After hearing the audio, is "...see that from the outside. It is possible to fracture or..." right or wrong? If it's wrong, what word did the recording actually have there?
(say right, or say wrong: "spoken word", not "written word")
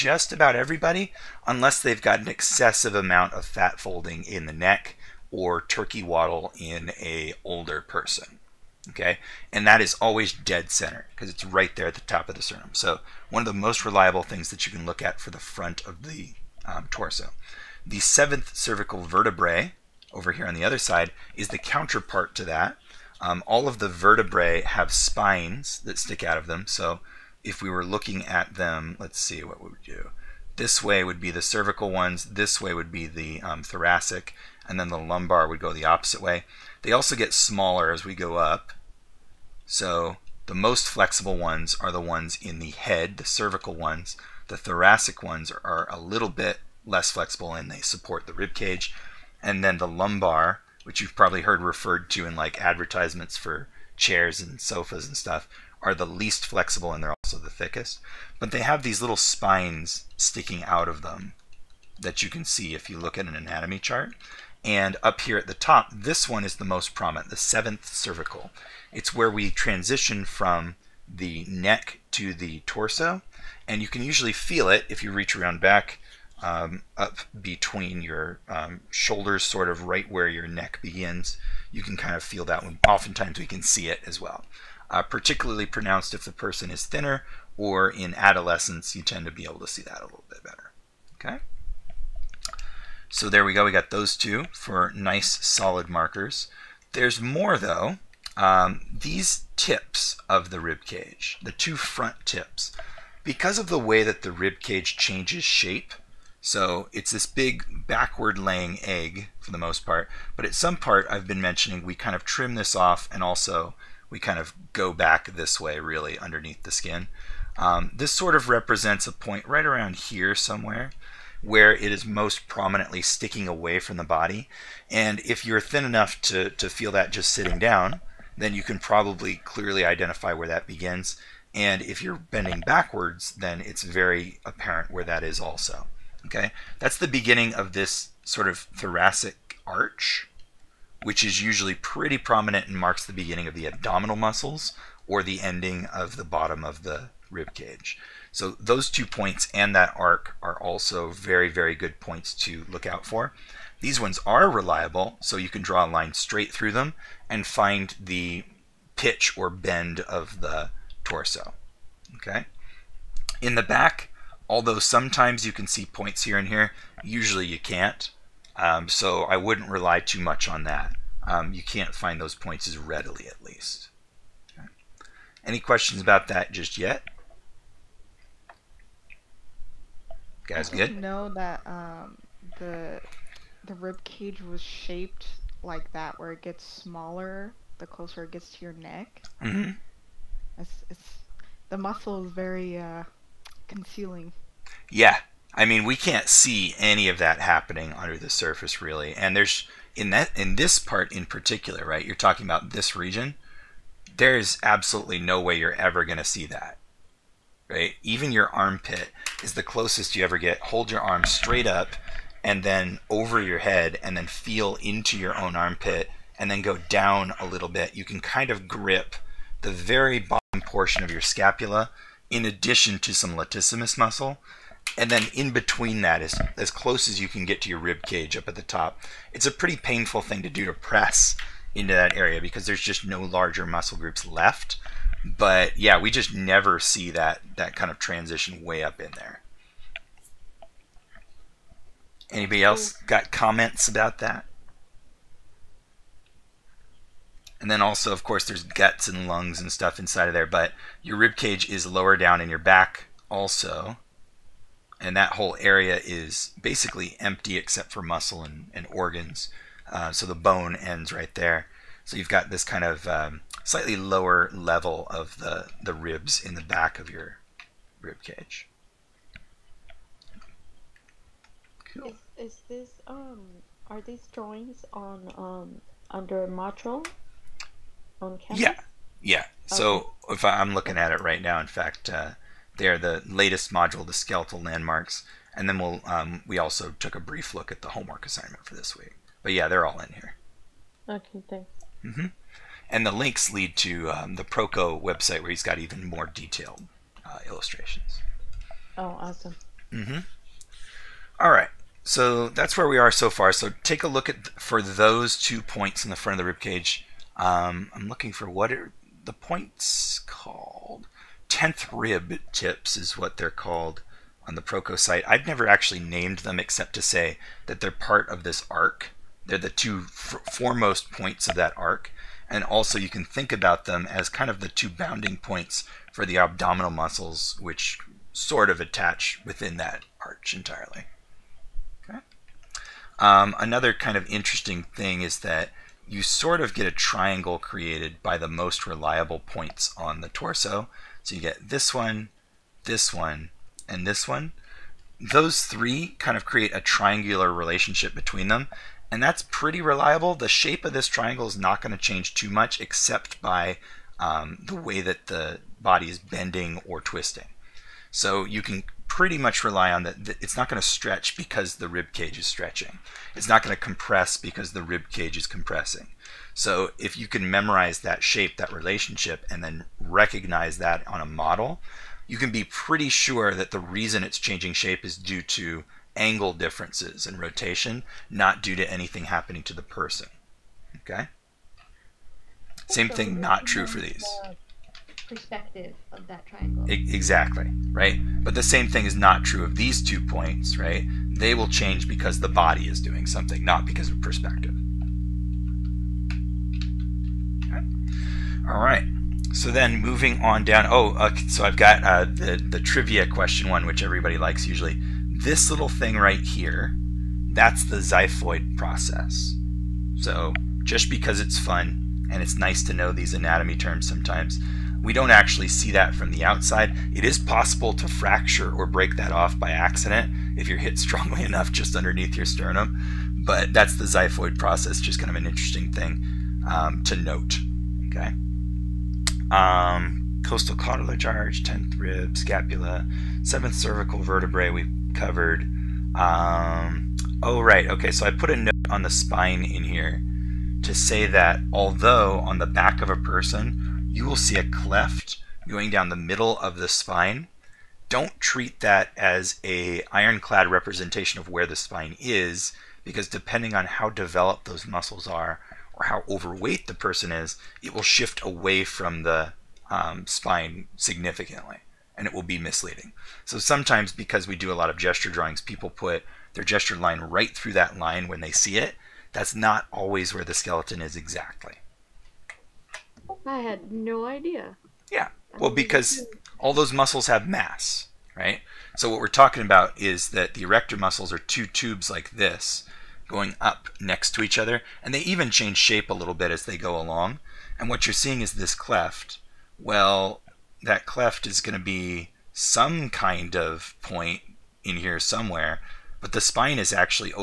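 right.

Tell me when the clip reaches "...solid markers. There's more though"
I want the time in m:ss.
1:35.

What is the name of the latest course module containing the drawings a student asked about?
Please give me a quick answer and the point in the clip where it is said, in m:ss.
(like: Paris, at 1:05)
Skeletal landmarks, at 4:44.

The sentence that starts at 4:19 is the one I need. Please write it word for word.
Uh, so the bone ends right there.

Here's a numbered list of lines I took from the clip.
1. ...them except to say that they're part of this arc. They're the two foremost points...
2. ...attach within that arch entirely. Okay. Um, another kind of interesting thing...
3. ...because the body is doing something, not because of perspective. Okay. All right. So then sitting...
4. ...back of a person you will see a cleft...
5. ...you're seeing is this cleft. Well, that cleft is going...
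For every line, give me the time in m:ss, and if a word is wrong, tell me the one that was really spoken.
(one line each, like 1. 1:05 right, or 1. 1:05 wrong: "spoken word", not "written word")
1. 5:16 right
2. 5:28 right
3. 6:32 wrong: "moving", not "sitting"
4. 7:22 right
5. 8:08 right.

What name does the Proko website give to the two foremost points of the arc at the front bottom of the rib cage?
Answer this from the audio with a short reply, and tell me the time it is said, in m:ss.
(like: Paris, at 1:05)
Tenth rib tips, at 5:11.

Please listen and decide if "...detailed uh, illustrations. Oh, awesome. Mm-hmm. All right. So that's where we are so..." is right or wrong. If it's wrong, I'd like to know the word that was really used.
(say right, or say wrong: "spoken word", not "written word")
right.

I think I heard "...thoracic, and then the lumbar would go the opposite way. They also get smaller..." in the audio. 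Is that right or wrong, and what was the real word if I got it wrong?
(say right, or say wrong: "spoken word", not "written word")
right.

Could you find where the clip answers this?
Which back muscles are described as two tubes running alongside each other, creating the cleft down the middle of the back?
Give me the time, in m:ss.
8:00.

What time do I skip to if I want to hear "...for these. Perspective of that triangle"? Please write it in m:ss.
6:23.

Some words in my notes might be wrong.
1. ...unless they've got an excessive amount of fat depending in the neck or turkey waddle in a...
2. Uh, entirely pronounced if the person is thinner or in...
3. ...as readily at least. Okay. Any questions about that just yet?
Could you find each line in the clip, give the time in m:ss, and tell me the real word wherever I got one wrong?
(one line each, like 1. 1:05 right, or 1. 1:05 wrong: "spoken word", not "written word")
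1. 0:01 wrong: "folding", not "depending"
2. 1:24 wrong: "particularly", not "entirely"
3. 2:52 right.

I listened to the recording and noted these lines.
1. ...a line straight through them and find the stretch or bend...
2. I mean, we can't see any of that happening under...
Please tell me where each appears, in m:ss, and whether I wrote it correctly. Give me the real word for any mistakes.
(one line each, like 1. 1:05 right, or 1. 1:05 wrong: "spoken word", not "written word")
1. 2:35 wrong: "pitch", not "stretch"
2. 3:15 right.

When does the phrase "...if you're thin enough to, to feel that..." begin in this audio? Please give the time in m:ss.
2:05.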